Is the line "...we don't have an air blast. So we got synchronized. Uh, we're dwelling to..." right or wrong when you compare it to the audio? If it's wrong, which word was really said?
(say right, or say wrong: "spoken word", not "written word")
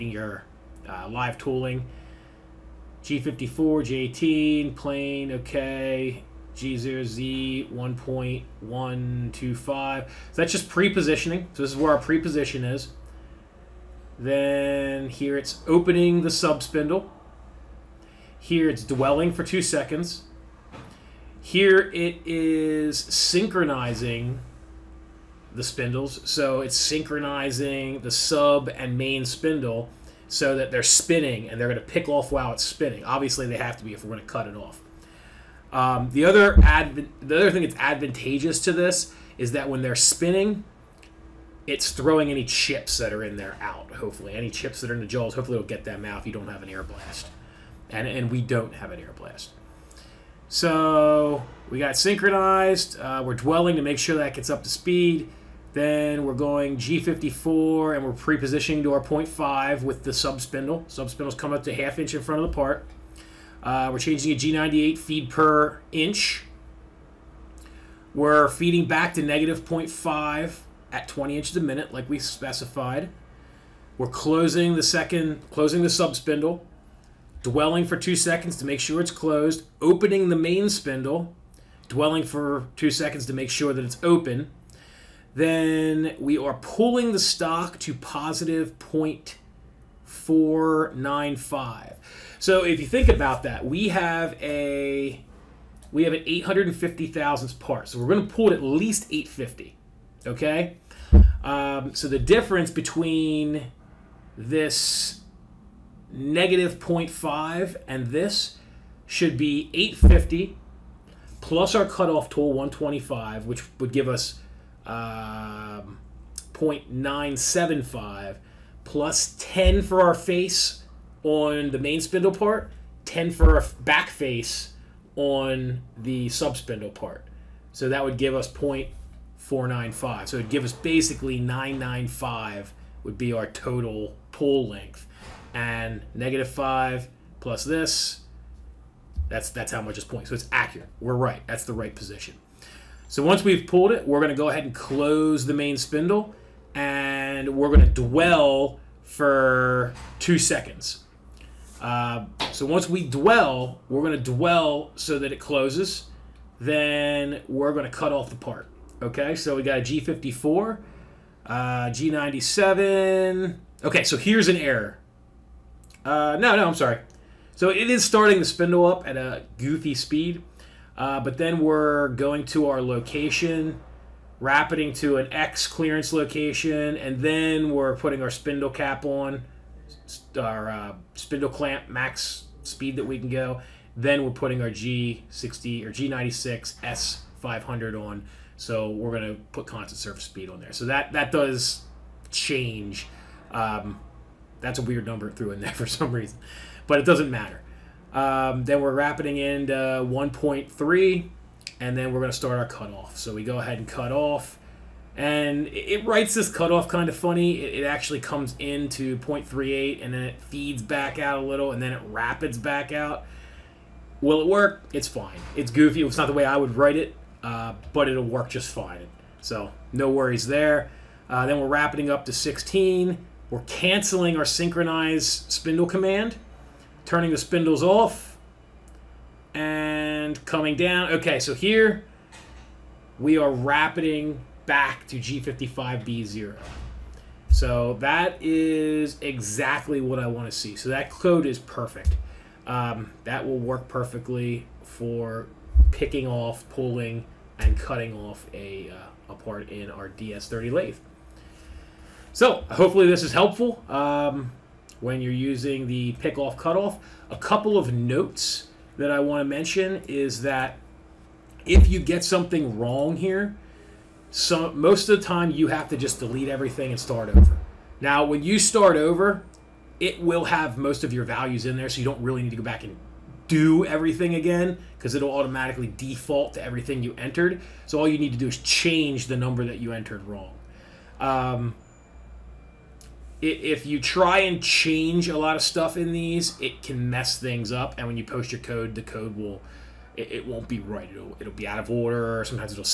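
right.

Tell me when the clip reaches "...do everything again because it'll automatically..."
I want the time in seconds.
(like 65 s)
273 s.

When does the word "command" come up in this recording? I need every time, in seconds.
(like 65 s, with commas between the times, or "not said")
225 s.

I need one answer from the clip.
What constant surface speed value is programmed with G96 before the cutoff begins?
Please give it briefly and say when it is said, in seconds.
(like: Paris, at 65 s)
S500, at 185 s.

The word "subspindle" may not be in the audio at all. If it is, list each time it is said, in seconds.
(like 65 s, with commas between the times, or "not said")
16 s, 126 s.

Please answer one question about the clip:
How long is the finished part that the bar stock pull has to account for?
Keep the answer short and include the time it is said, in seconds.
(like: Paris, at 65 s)
850 thousandths, at 96 s.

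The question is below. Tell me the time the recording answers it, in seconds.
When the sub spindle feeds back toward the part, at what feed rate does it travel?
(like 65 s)
71 s.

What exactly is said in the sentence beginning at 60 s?
Sub spindles coming up to half inch in front of the part.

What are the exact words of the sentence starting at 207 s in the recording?
It, it actually comes into 0.38, and then it feeds back out a little, and then it rapids back out.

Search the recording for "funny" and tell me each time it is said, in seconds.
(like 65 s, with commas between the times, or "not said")
207 s.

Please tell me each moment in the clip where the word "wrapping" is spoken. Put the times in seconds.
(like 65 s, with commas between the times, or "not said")
198 s, 221 s.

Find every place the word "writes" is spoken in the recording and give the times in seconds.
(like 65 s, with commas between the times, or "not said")
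206 s, 216 s.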